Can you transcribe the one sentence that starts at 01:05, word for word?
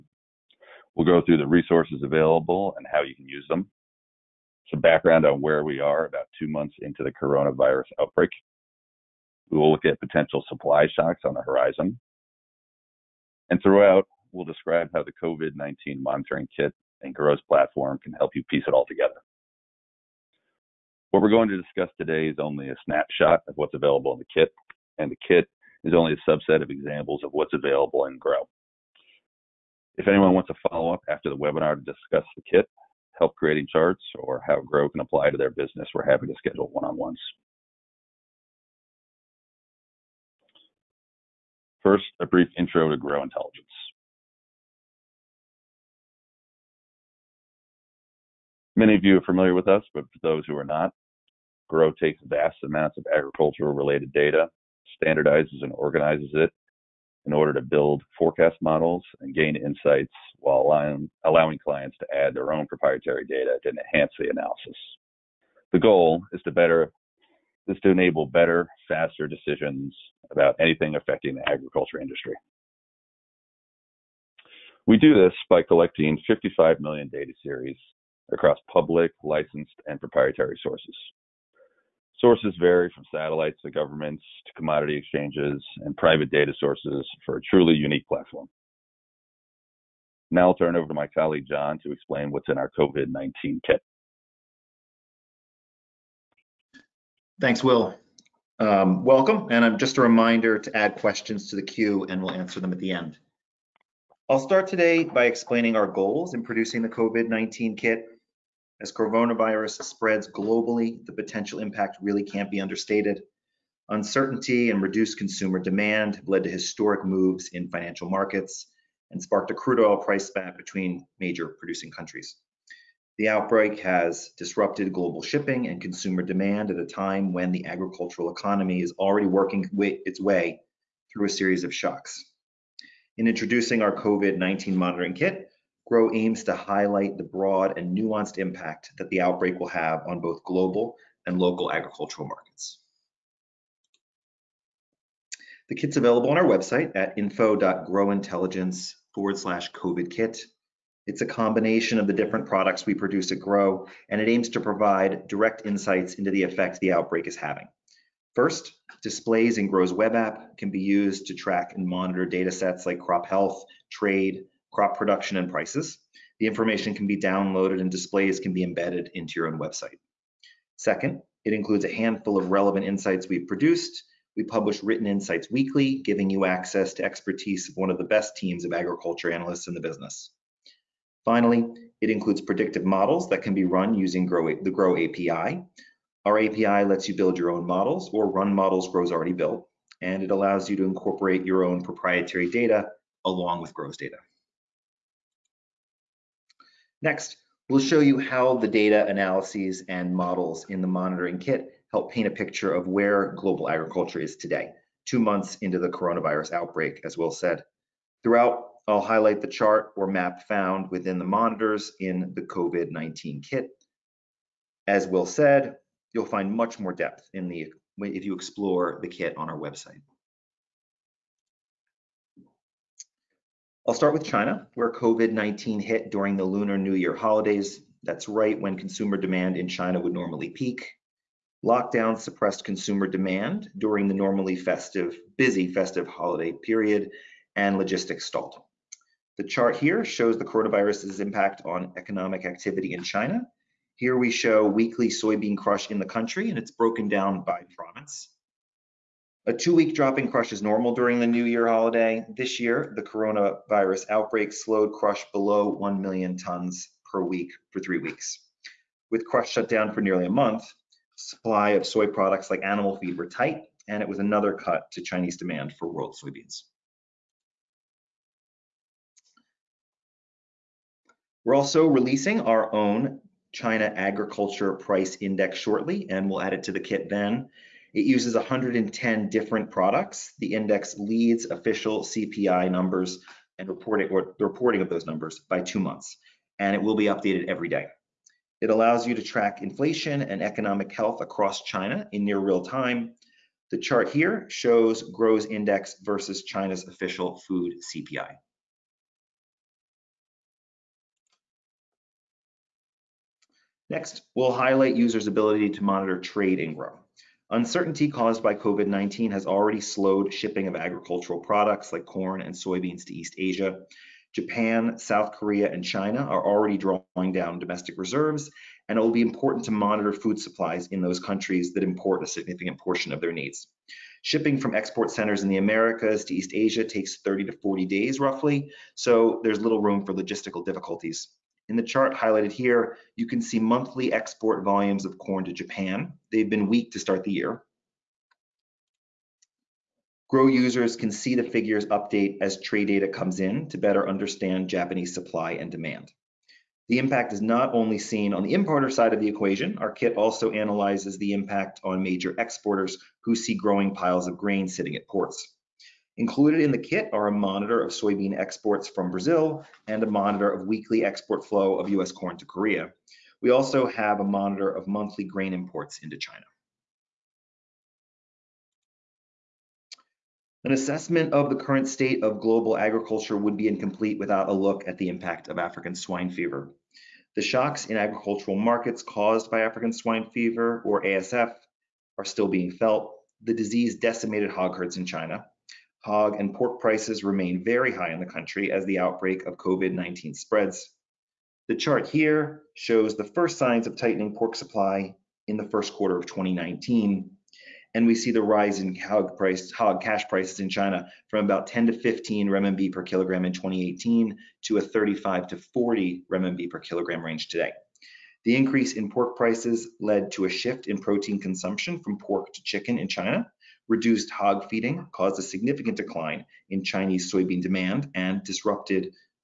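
The goal is to better is to enable better, faster decisions about anything affecting the agriculture industry.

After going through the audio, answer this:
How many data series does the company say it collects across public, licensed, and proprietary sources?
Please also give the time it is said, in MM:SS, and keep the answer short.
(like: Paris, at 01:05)
55 million, at 01:16.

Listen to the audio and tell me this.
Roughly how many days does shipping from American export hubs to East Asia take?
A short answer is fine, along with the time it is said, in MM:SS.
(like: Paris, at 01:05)
30 to 40 days, at 05:27.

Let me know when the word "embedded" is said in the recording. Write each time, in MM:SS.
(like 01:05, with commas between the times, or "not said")
02:48.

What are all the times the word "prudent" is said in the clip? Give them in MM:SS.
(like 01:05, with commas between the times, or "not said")
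not said.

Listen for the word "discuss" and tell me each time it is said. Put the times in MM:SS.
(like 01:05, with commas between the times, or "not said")
00:21, 00:31.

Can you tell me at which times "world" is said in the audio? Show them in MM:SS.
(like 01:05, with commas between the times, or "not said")
04:25.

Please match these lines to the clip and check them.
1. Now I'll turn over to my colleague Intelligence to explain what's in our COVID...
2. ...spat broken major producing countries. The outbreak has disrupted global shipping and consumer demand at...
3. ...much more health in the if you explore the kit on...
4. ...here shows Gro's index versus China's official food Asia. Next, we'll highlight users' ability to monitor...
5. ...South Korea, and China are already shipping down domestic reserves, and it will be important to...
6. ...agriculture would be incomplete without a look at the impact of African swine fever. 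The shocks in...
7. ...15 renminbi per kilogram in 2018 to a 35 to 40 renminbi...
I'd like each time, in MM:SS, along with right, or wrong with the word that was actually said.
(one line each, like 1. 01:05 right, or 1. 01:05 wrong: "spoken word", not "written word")
1. 01:30 wrong: "John", not "Intelligence"
2. 02:00 wrong: "between", not "broken"
3. 03:36 wrong: "depth", not "health"
4. 04:54 wrong: "CPI", not "Asia"
5. 05:14 wrong: "drawing", not "shipping"
6. 06:12 right
7. 06:41 right.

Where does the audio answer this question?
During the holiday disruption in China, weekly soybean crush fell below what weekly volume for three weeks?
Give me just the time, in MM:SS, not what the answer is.
04:15.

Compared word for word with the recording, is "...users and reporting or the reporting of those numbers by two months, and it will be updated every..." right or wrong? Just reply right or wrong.
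wrong.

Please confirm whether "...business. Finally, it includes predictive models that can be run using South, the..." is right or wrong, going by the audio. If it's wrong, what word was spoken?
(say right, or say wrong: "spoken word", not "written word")
wrong: "Gro", not "South".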